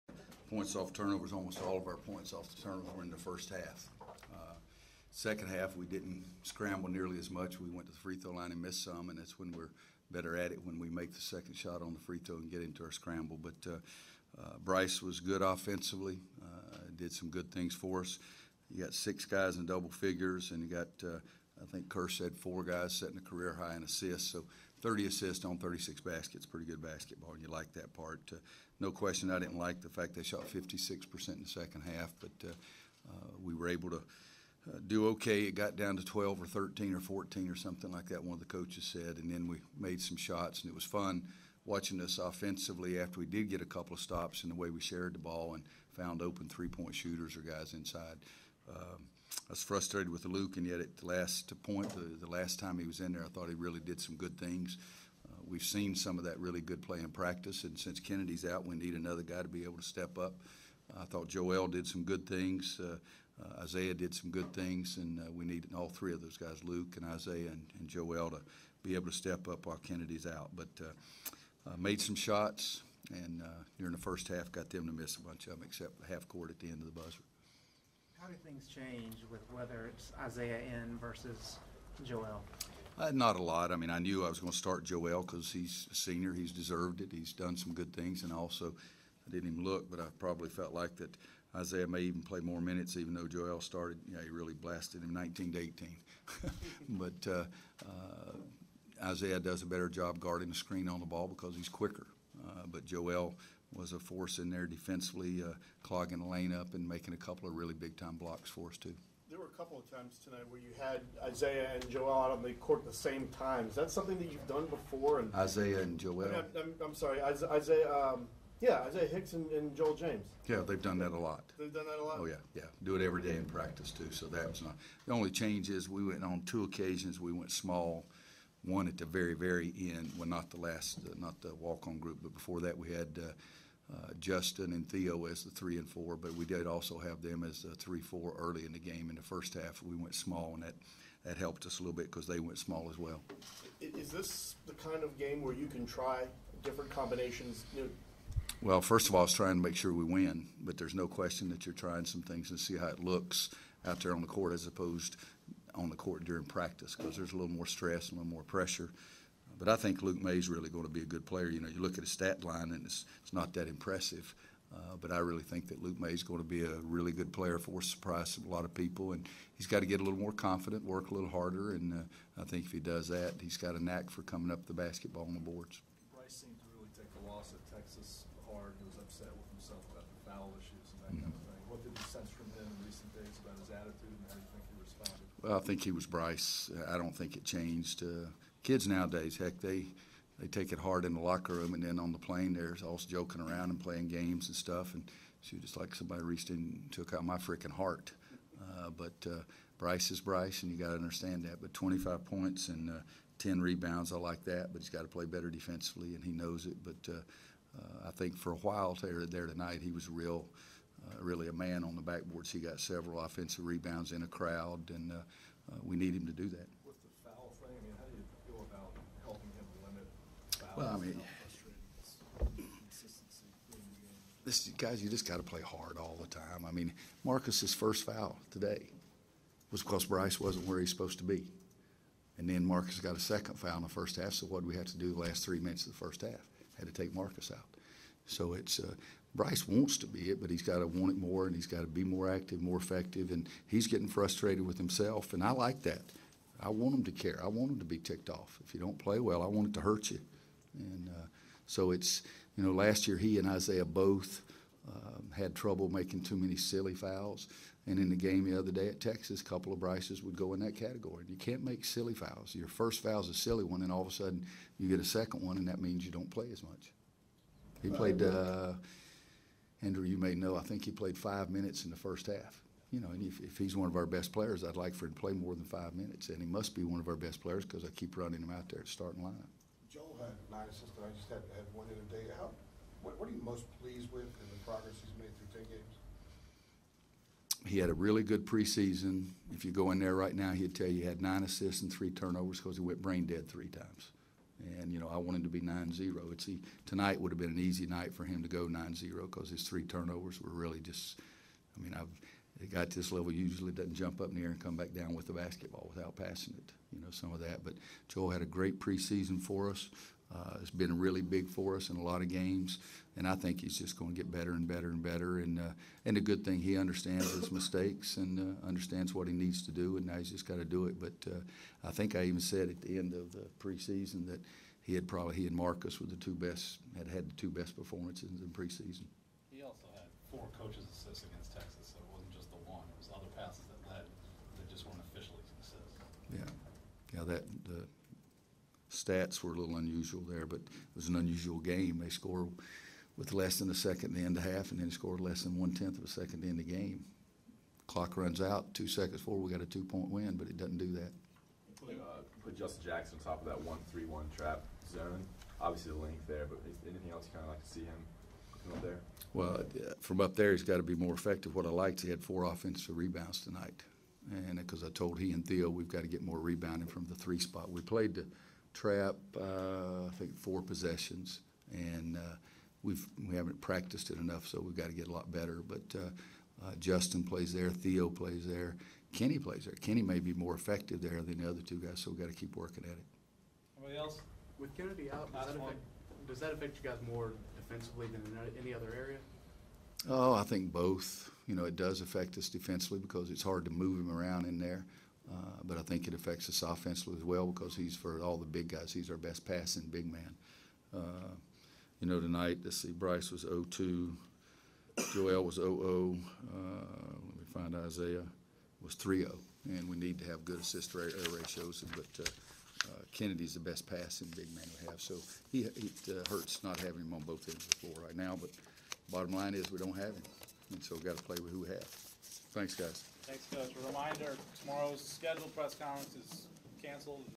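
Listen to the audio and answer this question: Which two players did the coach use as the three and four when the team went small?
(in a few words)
Justin and Theo.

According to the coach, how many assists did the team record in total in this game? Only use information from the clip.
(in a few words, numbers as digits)
30.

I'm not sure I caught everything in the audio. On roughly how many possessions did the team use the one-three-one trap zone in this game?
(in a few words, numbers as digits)
4.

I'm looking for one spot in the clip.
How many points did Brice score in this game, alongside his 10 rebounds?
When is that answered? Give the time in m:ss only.
3:21.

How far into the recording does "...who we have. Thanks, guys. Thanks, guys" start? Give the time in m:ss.
7:01.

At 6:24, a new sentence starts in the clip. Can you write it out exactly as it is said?
With Kennedy out, does that, affect, does that affect you guys more defensively than in any other area?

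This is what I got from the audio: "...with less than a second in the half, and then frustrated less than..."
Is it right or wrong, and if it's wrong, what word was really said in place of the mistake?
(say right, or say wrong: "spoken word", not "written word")
wrong: "scored", not "frustrated".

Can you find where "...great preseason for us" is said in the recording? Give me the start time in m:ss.
5:08.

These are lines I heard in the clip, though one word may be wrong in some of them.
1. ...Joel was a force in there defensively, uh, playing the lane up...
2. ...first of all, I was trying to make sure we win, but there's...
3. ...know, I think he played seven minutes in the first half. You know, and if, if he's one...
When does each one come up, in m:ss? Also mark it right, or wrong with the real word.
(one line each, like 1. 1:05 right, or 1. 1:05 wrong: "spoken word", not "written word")
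1. 1:42 wrong: "clogging", not "playing"
2. 2:28 right
3. 4:30 wrong: "five", not "seven".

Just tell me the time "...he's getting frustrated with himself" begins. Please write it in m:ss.
4:03.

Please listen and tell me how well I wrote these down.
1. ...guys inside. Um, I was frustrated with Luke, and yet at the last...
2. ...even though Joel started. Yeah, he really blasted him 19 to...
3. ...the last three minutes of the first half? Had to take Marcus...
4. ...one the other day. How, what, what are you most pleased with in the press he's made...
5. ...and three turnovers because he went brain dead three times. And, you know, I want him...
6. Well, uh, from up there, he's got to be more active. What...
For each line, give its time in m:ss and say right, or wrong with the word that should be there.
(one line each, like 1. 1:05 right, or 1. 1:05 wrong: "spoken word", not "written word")
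1. 0:47 right
2. 1:32 right
3. 3:55 right
4. 4:41 wrong: "progress", not "press"
5. 4:51 right
6. 5:59 wrong: "effective", not "active".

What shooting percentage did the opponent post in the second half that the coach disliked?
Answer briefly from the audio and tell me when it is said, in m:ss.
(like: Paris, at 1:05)
56%, at 0:30.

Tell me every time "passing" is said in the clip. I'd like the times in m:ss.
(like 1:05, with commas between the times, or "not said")
5:06, 6:39, 6:53.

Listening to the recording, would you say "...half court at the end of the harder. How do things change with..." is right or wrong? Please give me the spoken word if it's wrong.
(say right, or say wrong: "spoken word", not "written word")
wrong: "buzzer", not "harder".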